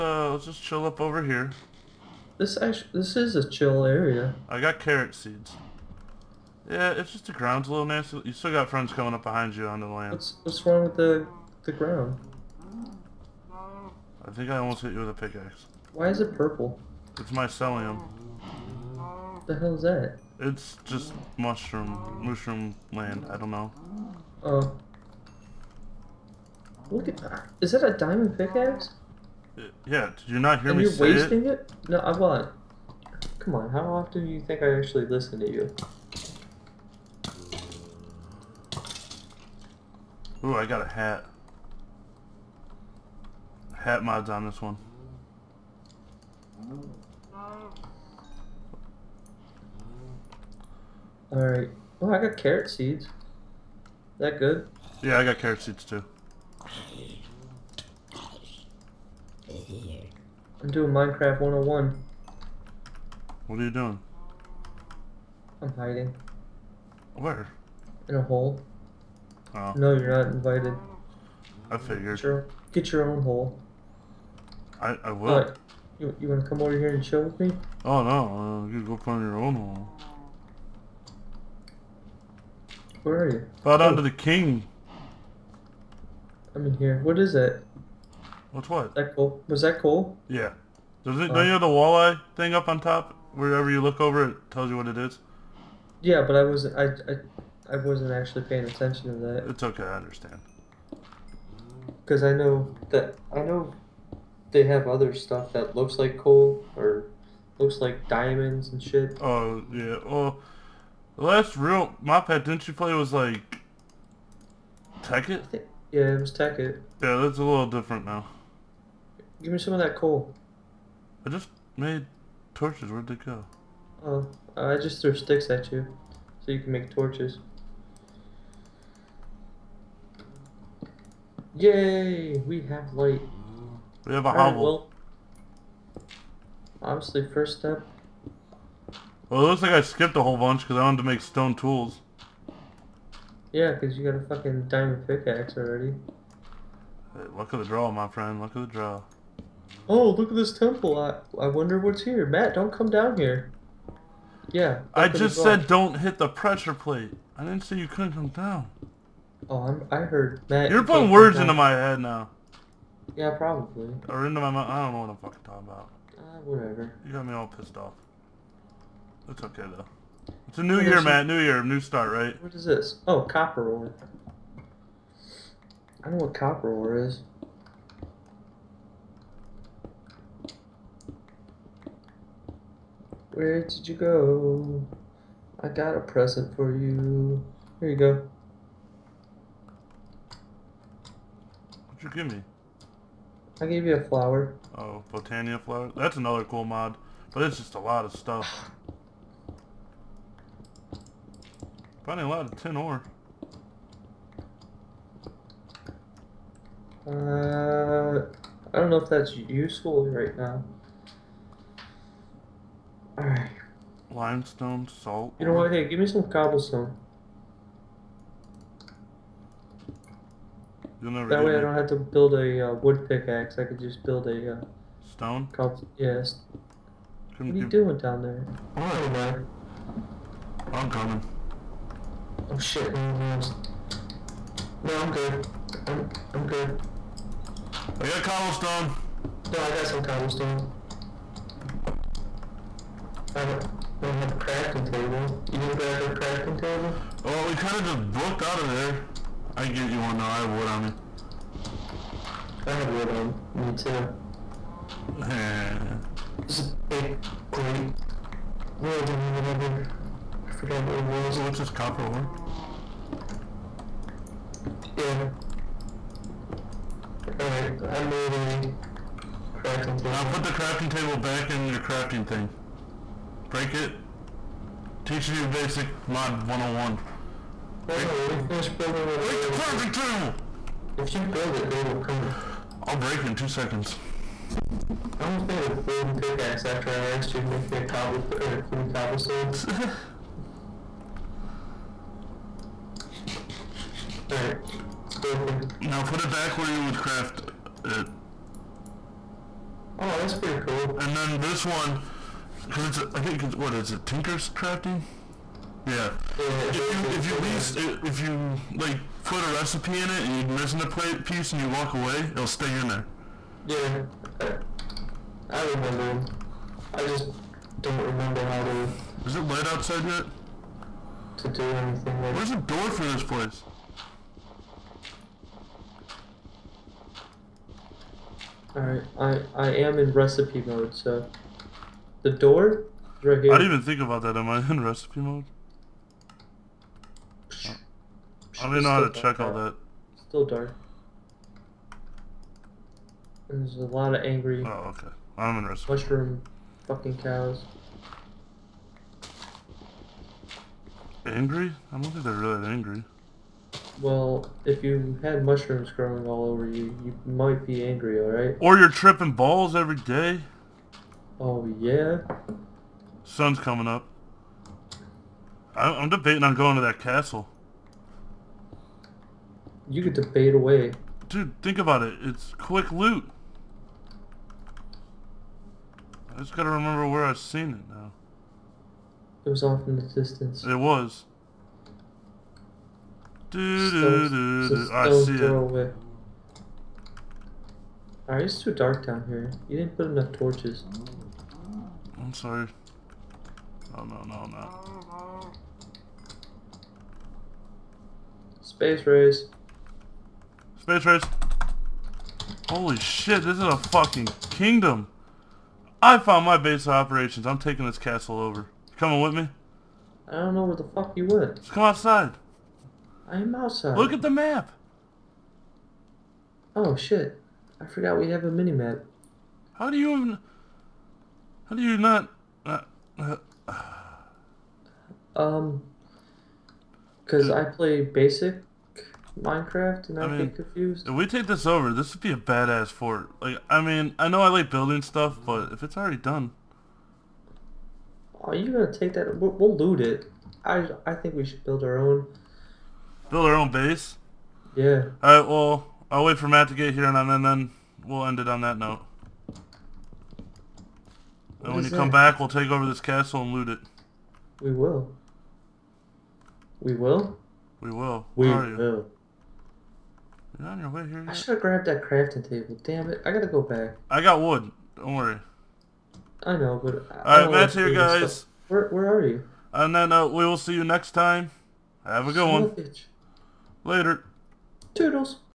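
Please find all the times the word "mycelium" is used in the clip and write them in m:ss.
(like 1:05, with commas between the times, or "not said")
0:17.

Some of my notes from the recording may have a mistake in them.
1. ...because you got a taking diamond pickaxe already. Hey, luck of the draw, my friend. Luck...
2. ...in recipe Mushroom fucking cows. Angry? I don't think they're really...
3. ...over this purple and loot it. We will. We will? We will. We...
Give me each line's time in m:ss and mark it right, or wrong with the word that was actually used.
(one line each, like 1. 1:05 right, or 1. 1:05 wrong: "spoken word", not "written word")
1. 2:23 wrong: "fucking", not "taking"
2. 5:45 right
3. 7:32 wrong: "castle", not "purple".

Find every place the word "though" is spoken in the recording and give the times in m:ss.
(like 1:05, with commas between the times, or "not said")
2:49, 4:10.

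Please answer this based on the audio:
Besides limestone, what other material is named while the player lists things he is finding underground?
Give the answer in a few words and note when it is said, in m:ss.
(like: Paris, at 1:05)
Salt, at 3:34.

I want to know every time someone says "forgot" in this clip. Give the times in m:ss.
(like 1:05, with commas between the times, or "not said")
4:20, 6:57.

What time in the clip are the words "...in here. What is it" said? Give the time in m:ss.
1:26.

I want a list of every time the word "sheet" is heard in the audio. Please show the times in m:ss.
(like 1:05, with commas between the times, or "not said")
not said.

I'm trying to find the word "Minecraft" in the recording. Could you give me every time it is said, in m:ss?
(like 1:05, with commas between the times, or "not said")
1:00, 7:09.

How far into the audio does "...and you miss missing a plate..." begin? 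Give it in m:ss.
5:10.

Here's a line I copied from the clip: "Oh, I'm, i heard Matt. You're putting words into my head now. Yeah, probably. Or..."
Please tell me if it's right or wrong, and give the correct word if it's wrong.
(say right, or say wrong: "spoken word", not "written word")
right.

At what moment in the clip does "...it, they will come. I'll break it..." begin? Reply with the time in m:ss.
4:41.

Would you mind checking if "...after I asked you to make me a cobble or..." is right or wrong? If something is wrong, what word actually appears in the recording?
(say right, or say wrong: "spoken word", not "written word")
right.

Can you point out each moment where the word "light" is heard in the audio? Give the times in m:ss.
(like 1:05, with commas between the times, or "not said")
2:12, 5:19.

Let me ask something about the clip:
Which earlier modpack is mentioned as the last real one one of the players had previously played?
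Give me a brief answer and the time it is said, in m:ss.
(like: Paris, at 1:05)
Tekkit, at 1:55.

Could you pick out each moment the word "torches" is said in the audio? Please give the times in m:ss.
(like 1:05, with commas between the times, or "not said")
2:02, 2:06, 6:30.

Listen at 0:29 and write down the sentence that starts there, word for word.
Uh, yeah, did you not hear and me you're wasting it?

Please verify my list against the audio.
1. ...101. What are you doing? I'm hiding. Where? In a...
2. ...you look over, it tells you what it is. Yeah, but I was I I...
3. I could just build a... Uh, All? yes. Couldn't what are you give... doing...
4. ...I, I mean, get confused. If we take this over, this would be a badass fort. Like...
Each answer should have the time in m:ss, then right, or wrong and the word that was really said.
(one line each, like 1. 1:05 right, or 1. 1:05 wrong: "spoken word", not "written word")
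1. 1:01 right
2. 1:33 right
3. 3:43 wrong: "Stone", not "All"
4. 7:10 right.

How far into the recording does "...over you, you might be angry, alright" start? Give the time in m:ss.
5:56.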